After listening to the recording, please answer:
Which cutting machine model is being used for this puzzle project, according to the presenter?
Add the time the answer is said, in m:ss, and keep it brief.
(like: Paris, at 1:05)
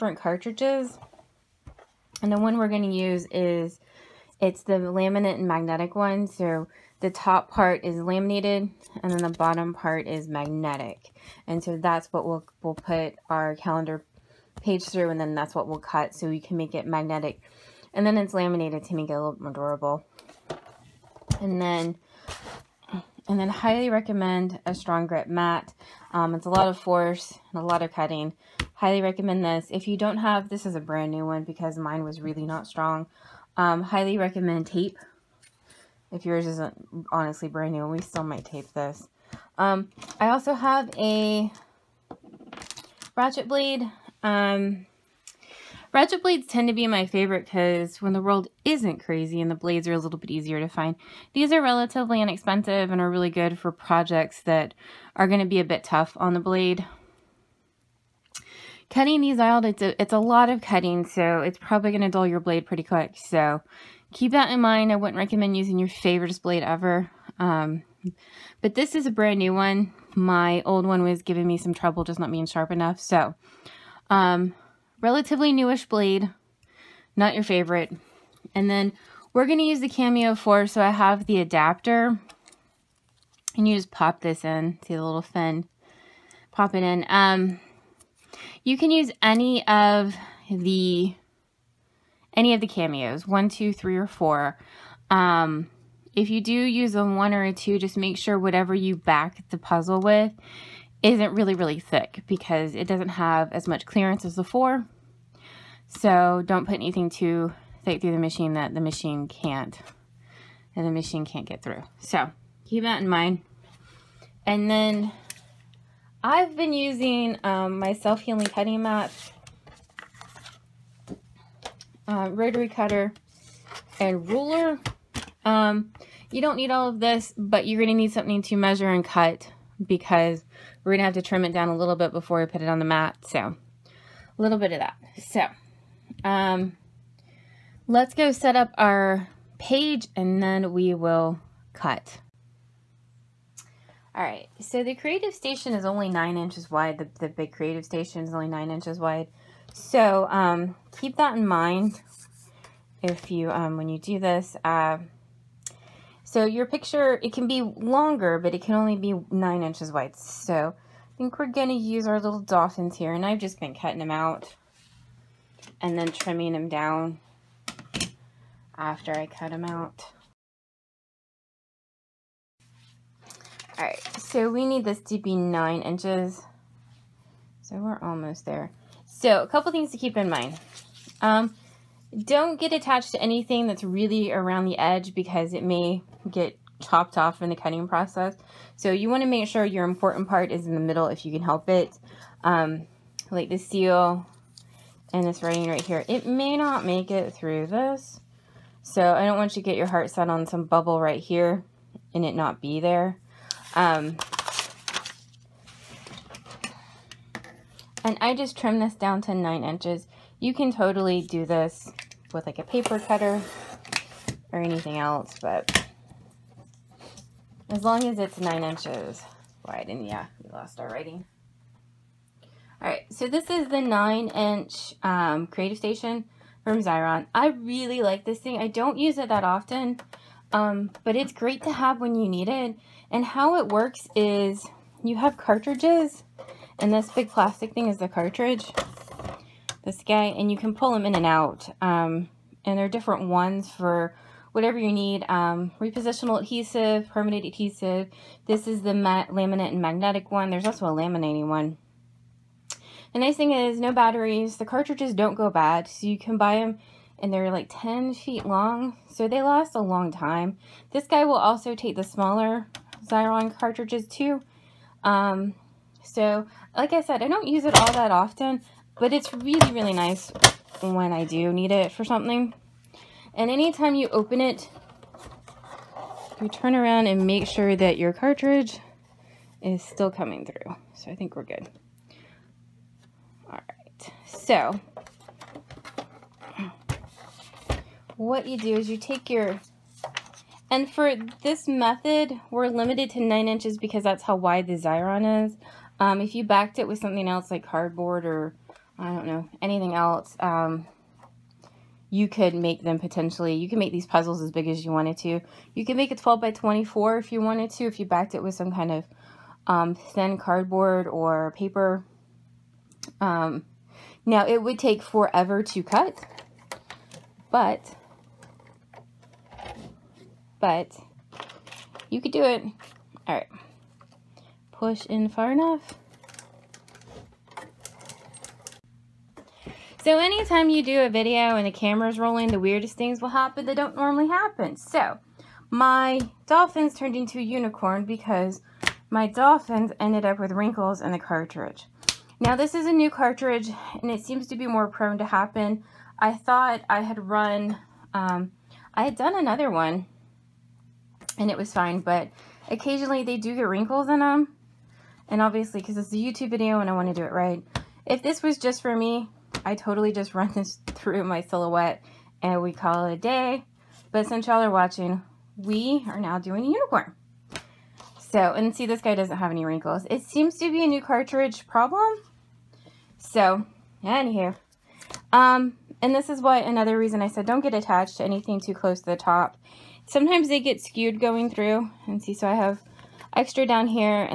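Cameo 4, at 1:19.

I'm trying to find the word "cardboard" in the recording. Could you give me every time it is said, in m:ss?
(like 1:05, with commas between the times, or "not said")
4:57, 5:10.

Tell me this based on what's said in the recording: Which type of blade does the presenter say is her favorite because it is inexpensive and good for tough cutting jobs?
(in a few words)
ratchet blade.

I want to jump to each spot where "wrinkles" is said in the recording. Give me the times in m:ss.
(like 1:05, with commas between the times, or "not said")
5:40, 5:53, 6:09.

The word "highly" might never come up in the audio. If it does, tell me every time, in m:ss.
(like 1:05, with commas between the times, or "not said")
0:23, 0:28, 0:33.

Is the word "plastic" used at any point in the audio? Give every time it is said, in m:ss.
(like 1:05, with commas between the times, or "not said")
3:57.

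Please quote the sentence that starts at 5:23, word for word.
All right push in far enough.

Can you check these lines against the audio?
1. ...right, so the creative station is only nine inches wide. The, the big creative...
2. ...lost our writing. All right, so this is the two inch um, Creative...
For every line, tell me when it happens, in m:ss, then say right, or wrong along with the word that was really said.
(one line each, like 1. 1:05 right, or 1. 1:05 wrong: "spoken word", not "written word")
1. 2:24 right
2. 3:40 wrong: "nine", not "two".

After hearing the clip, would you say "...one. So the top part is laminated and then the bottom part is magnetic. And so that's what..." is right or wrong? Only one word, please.
right.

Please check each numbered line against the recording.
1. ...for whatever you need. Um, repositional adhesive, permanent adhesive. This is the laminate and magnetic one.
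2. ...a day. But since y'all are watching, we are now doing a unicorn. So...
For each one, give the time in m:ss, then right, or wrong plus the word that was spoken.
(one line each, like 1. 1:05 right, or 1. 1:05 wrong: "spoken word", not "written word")
1. 4:03 right
2. 6:03 right.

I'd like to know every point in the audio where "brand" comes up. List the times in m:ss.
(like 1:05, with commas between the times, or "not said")
0:30, 0:37, 1:09.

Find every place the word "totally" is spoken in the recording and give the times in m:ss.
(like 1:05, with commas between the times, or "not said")
3:30, 5:59.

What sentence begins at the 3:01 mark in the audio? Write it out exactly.
Um, don't get attached to anything that's really around the edge because it may get chopped off in the cutting process.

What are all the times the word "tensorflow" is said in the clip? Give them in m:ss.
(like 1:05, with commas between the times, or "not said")
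not said.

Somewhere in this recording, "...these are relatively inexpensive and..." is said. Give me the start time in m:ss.
0:51.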